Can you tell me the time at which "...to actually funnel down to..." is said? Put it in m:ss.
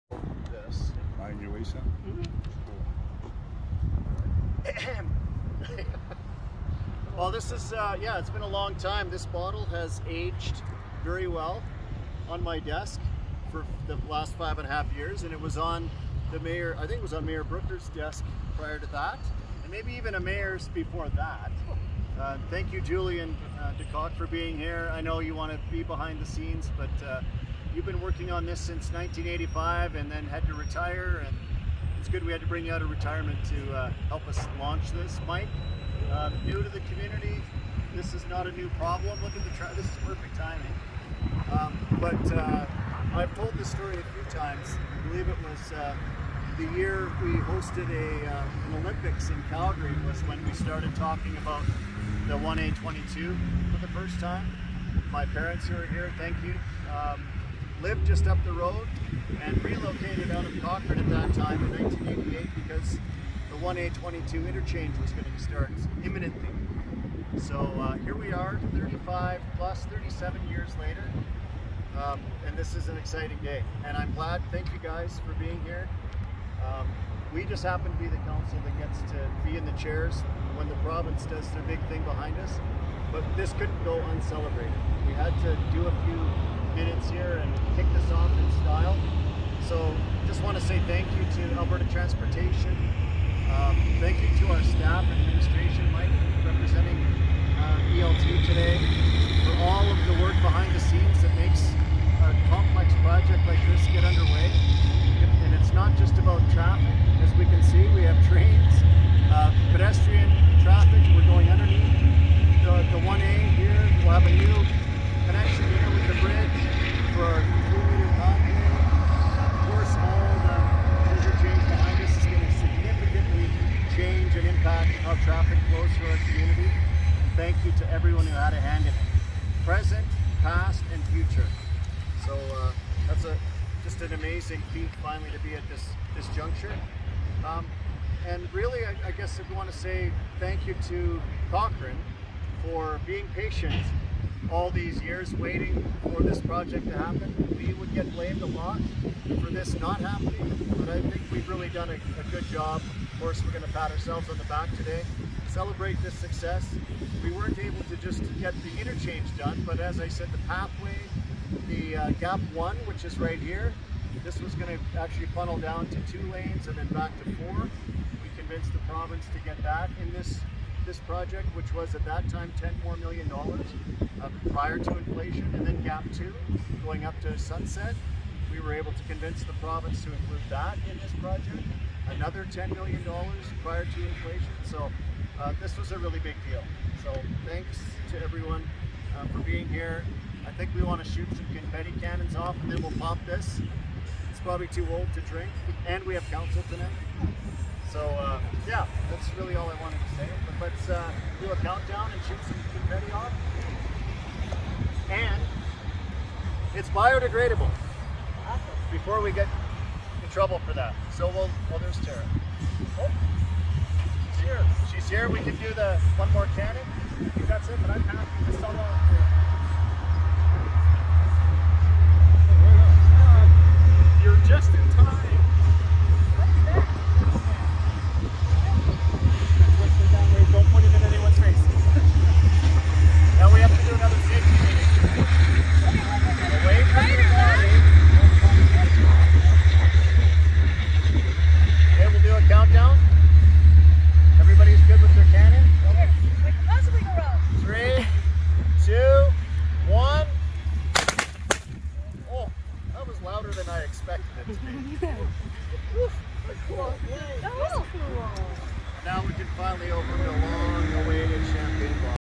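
2:44.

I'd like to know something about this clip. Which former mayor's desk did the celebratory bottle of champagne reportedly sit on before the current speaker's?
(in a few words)
Mayor Brooker.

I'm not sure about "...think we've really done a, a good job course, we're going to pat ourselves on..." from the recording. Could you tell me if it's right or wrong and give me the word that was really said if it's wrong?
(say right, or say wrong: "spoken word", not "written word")
right.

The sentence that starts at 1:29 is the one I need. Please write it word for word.
So just want to say thank you to Alberta Transportation.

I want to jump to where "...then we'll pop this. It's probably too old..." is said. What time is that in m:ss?
3:12.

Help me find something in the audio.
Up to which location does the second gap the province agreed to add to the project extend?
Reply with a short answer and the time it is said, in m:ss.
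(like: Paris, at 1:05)
Sunset, at 2:57.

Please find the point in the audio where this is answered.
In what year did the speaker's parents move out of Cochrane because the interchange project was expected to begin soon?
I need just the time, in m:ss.
1:01.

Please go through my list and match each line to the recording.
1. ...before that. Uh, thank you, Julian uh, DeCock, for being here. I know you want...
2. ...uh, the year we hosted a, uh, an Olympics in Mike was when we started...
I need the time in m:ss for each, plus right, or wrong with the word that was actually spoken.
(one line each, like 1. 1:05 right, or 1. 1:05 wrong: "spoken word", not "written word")
1. 0:20 right
2. 0:45 wrong: "Calgary", not "Mike".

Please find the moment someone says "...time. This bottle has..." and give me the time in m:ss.
0:08.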